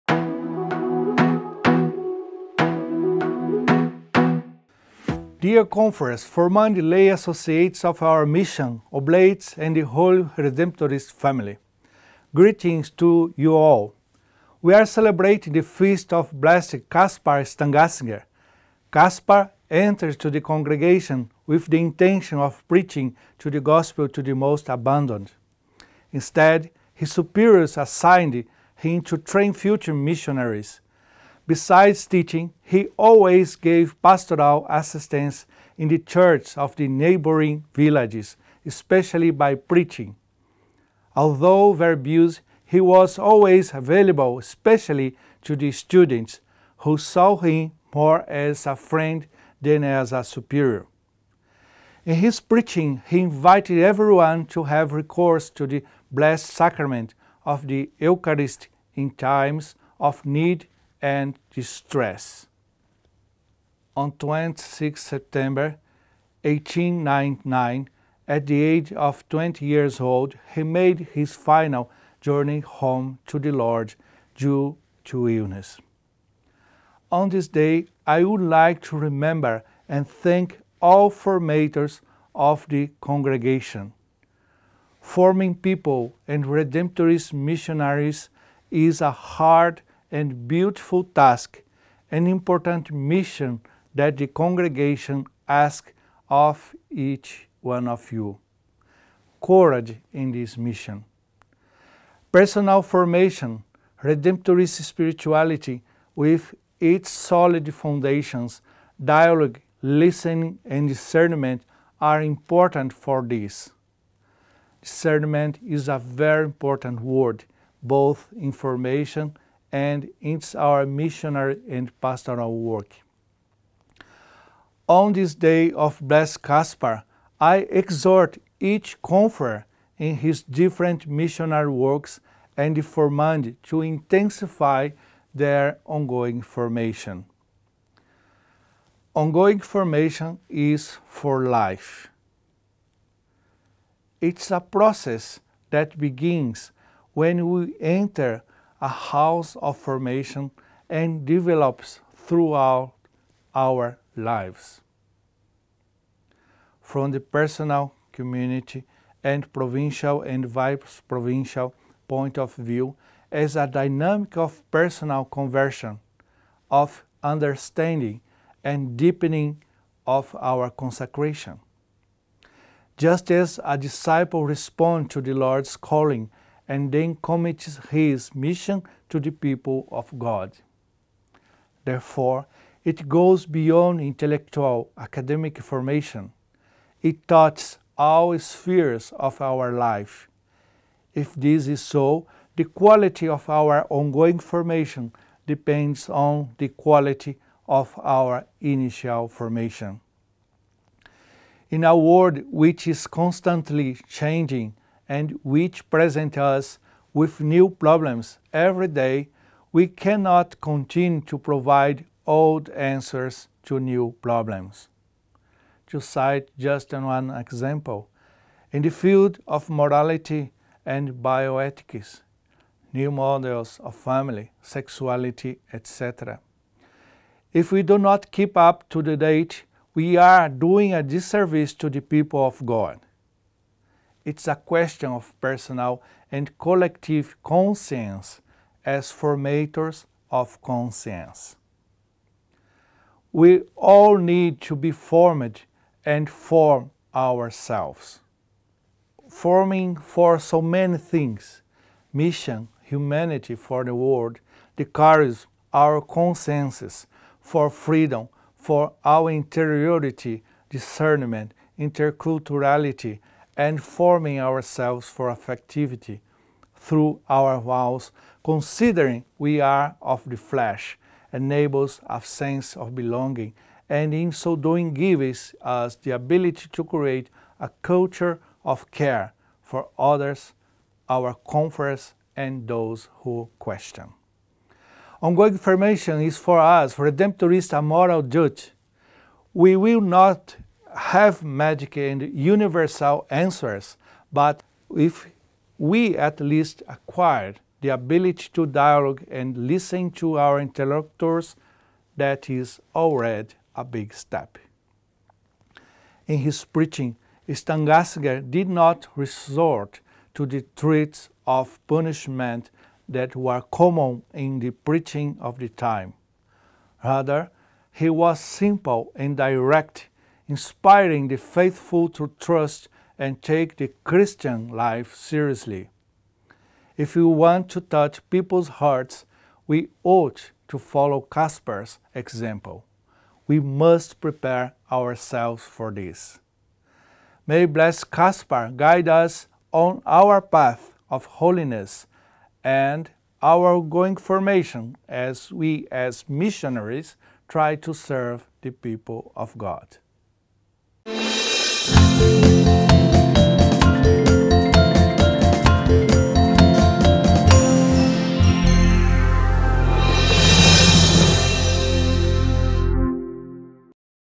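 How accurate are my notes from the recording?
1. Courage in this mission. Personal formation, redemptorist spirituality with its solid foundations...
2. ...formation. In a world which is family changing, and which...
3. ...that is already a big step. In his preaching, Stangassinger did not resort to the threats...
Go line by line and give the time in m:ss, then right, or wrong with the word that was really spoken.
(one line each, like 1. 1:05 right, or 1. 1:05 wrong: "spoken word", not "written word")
1. 1:39 right
2. 3:19 wrong: "constantly", not "family"
3. 5:02 right.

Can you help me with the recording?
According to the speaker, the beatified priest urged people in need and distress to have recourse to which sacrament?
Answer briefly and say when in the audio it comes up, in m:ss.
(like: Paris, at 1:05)
Eucharist, at 0:57.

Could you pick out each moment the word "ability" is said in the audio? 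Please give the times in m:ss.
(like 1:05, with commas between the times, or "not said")
4:36, 4:57.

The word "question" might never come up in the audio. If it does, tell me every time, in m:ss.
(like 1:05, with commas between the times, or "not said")
3:54, 4:43.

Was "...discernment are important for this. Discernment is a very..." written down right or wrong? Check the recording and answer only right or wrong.
right.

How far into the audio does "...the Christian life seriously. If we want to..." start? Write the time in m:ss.
5:23.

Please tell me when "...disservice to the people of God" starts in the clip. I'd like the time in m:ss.
3:51.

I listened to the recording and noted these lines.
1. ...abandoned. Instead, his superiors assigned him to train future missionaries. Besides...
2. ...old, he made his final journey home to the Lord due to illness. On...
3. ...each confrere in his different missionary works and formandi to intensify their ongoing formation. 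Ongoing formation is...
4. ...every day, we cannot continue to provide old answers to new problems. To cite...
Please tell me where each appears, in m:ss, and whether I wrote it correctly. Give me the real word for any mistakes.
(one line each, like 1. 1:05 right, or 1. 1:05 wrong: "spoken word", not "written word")
1. 0:24 right
2. 1:09 right
3. 2:08 right
4. 3:28 right.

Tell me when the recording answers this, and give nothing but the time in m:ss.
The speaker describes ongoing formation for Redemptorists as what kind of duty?
4:47.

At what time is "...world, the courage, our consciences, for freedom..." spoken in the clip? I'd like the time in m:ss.
4:13.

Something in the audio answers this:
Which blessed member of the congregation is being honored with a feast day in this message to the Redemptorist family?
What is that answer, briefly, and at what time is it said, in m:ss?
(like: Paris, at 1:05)
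Gaspar Stangassinger, at 0:16.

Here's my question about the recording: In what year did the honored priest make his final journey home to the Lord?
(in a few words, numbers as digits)
1899.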